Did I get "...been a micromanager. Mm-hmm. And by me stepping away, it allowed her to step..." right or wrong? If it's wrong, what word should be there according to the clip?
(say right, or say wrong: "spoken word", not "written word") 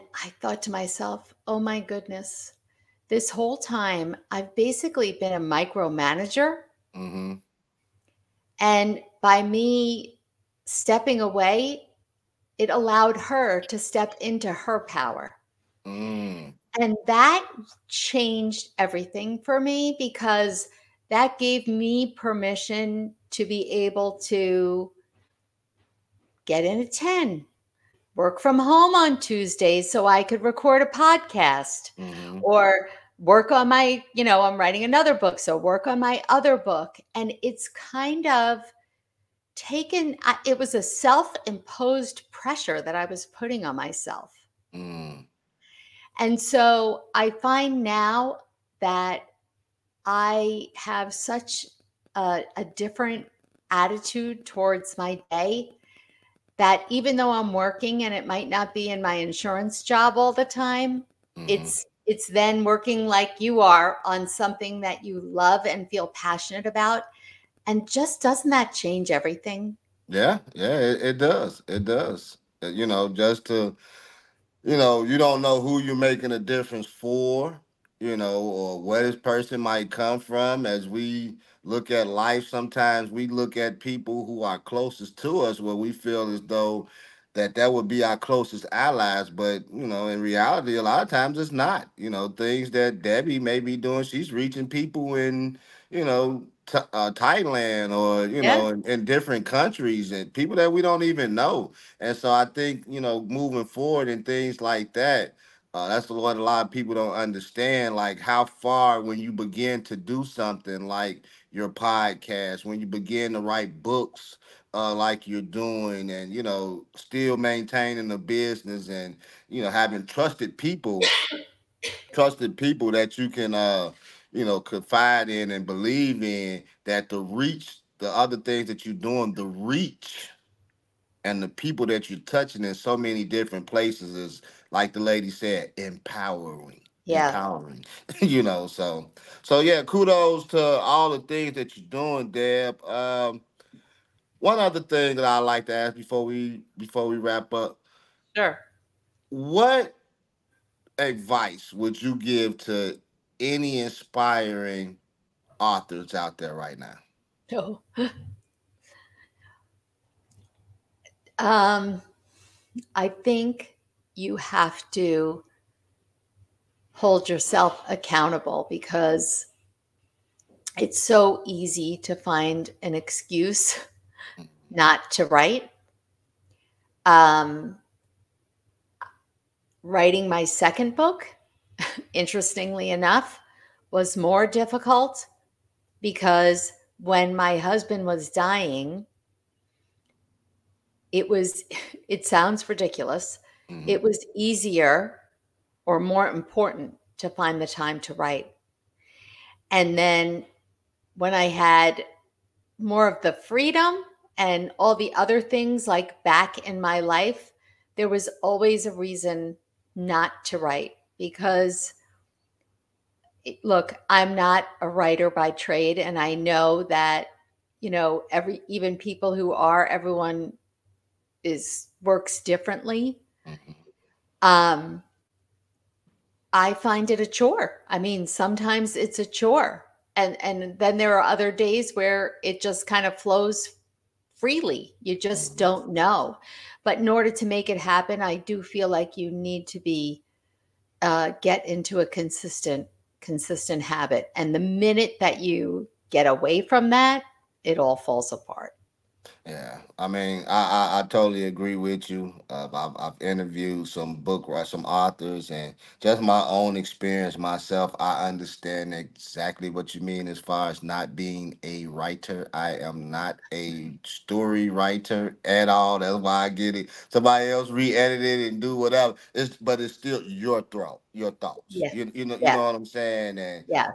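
right.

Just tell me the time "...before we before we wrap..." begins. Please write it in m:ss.
2:25.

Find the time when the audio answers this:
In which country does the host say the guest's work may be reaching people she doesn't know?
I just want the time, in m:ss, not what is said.
1:37.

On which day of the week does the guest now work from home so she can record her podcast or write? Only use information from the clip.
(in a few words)
Tuesdays.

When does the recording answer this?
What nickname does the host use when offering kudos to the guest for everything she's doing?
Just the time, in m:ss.
2:22.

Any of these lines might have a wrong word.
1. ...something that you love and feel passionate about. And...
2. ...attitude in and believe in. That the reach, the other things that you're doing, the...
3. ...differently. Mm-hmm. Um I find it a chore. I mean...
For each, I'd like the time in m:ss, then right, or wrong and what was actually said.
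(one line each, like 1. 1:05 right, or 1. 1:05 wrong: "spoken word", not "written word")
1. 1:04 right
2. 2:04 wrong: "confide", not "attitude"
3. 3:42 right.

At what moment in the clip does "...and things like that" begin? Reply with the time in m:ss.
1:44.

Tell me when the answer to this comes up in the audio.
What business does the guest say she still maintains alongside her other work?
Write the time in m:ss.
0:59.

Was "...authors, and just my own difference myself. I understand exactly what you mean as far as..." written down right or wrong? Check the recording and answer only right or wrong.
wrong.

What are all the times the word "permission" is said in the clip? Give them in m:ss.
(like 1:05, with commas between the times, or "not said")
0:22.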